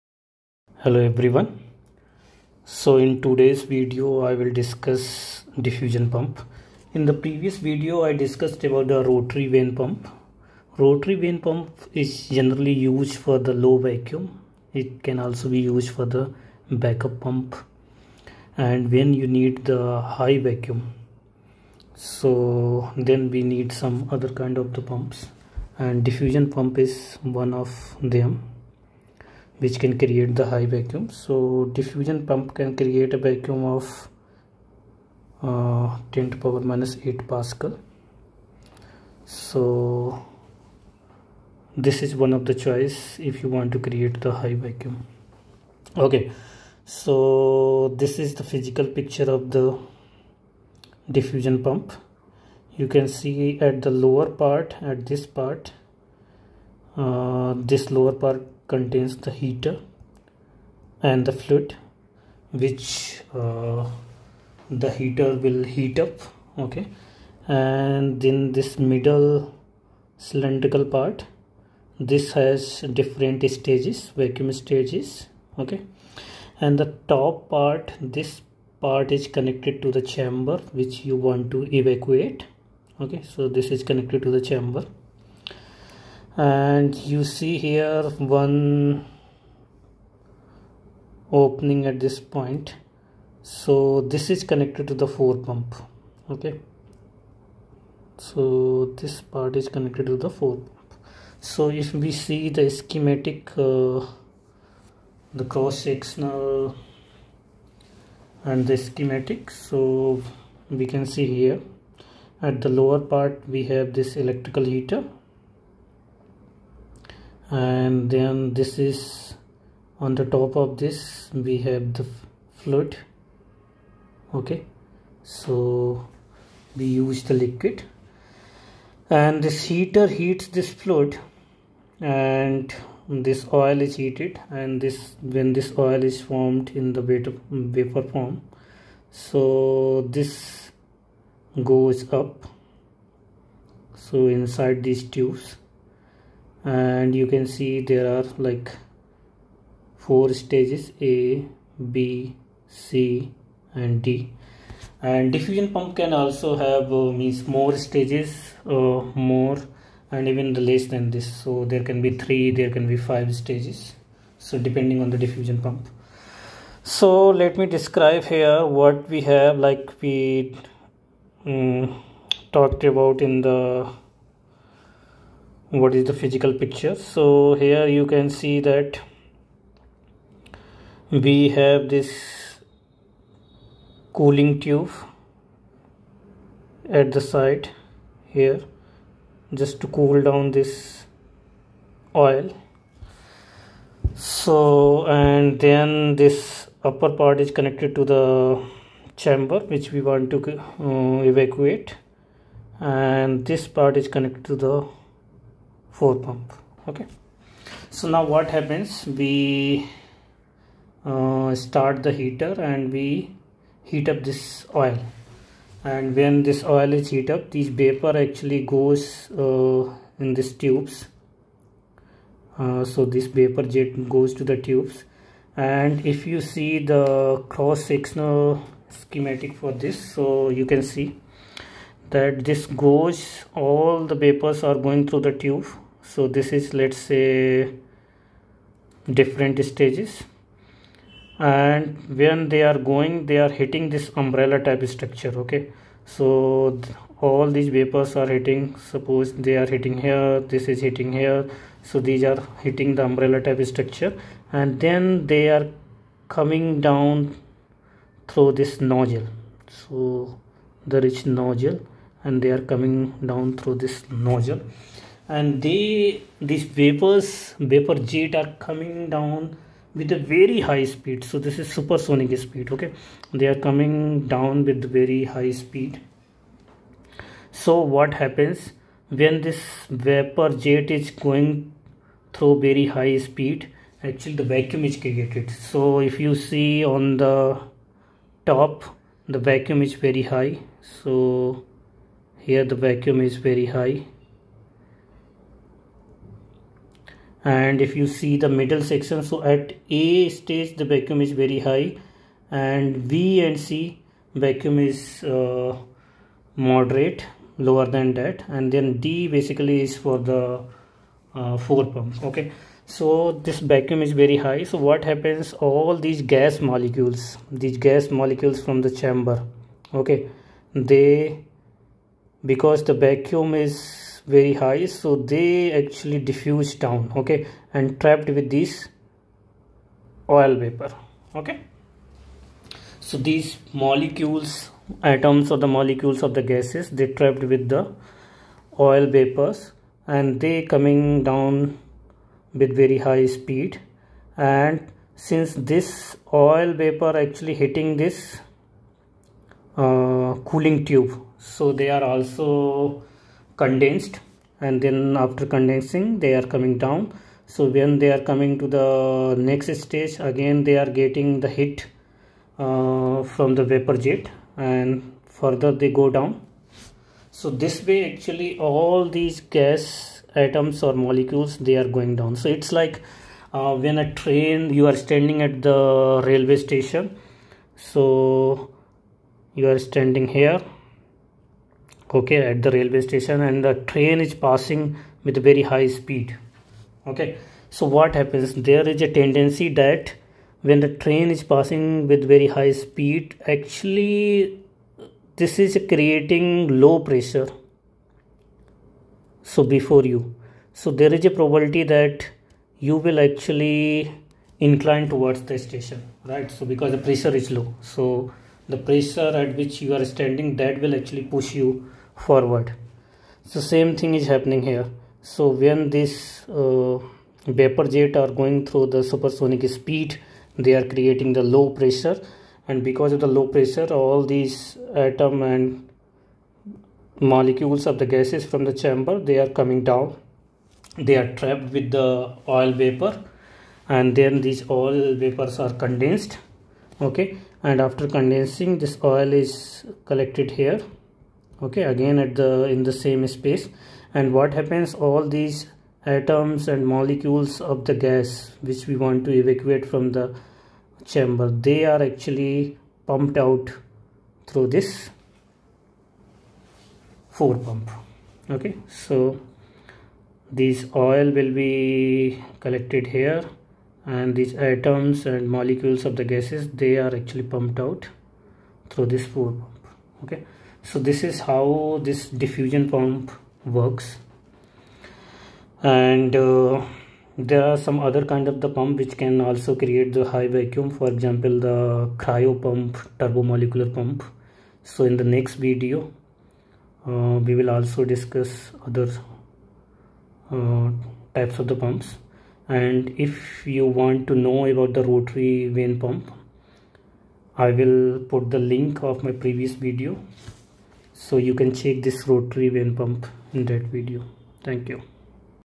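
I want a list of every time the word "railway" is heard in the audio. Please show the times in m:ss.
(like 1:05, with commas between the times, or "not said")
6:16, 6:22.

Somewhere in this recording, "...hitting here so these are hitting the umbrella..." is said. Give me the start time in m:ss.
4:10.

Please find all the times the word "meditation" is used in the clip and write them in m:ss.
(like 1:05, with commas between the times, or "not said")
not said.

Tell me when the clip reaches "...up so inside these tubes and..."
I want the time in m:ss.
2:22.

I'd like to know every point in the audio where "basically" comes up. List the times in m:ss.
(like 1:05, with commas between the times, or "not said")
5:09.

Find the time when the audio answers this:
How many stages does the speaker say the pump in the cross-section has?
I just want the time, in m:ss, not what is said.
2:29.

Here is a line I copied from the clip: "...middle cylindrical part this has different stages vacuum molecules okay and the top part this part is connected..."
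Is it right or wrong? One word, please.
wrong.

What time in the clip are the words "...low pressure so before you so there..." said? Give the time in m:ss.
6:36.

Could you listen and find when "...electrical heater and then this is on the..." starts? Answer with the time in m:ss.
1:54.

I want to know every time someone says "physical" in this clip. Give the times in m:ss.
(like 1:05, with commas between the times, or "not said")
0:48, 2:56.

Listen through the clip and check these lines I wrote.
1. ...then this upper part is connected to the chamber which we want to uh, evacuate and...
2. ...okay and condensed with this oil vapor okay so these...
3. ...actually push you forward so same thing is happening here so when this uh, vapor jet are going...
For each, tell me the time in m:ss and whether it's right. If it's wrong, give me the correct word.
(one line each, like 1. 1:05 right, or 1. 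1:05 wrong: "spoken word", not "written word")
1. 3:15 right
2. 5:27 wrong: "trapped", not "condensed"
3. 6:50 right.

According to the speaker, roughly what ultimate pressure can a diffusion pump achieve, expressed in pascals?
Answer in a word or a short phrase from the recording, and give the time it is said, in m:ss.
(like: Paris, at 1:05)
10^-8 pascal, at 0:36.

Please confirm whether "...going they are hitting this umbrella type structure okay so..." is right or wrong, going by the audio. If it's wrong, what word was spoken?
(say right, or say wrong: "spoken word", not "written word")
right.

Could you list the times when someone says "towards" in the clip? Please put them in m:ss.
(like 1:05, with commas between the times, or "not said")
6:45.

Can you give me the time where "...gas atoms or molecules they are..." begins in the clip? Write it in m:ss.
6:09.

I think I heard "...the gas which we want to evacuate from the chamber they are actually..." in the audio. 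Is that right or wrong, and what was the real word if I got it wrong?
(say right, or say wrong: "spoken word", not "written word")
right.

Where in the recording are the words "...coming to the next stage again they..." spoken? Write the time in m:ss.
5:58.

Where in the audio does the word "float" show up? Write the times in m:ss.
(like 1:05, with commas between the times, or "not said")
2:02, 2:10.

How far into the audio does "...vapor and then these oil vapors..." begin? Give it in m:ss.
7:12.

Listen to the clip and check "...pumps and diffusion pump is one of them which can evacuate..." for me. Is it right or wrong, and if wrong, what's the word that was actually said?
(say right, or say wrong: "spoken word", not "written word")
wrong: "create", not "evacuate".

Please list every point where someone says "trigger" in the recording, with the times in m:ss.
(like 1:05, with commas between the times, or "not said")
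not said.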